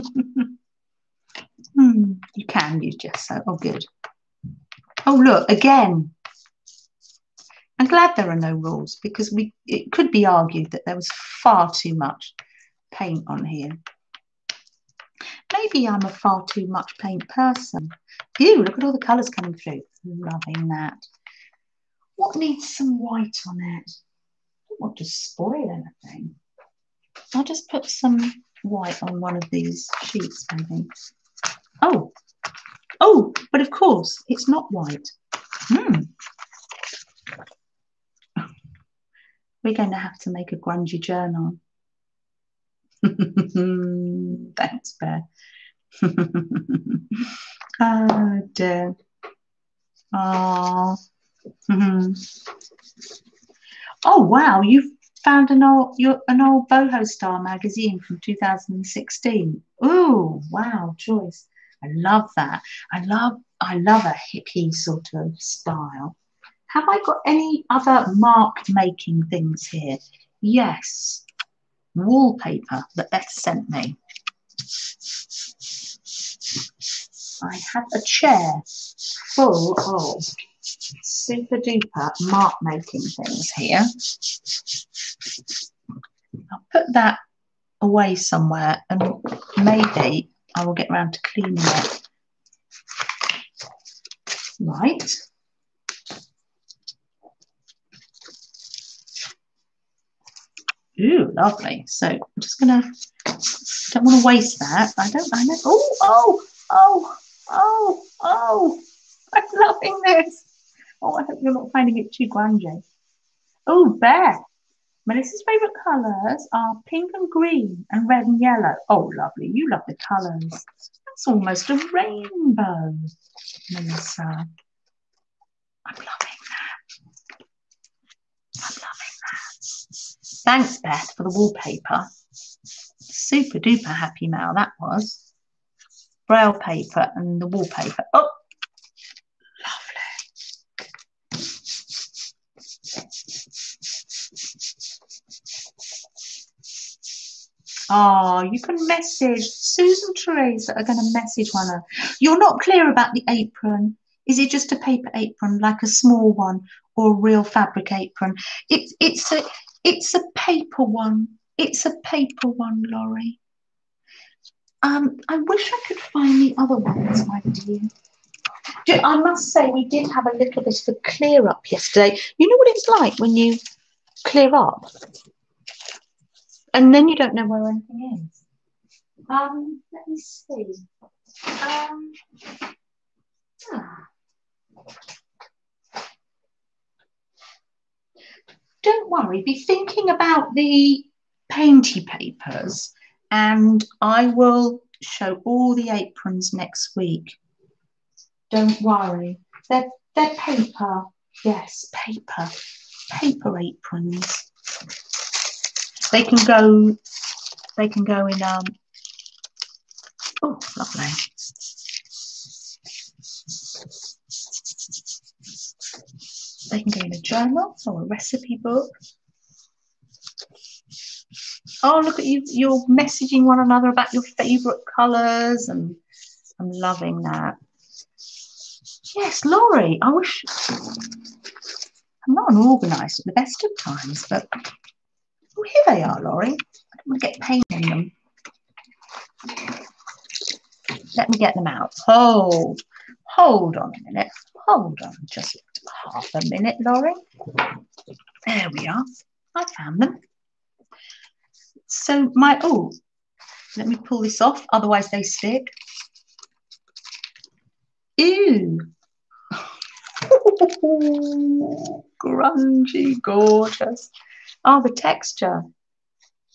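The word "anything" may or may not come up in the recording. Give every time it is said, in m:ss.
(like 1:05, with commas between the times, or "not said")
0:26, 2:57.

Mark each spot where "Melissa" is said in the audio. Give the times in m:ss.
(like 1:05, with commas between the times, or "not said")
1:55, 2:03.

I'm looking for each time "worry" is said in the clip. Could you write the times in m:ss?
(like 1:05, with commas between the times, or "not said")
3:09, 3:18.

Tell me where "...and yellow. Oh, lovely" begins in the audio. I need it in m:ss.
1:58.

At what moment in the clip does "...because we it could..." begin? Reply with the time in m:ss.
0:09.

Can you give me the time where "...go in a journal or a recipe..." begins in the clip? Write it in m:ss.
3:36.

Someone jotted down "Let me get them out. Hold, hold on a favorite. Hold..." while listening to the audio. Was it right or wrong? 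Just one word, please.
wrong.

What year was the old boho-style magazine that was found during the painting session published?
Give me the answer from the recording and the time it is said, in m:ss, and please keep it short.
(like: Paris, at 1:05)
2016, at 0:58.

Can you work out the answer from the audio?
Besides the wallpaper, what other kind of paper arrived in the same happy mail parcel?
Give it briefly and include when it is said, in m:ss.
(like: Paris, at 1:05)
Braille paper, at 2:16.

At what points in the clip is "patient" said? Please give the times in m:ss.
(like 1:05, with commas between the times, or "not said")
not said.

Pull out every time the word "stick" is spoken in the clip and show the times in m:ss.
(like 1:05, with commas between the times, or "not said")
4:15.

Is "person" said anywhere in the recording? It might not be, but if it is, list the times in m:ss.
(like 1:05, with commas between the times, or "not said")
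0:17.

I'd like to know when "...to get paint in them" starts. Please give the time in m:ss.
3:57.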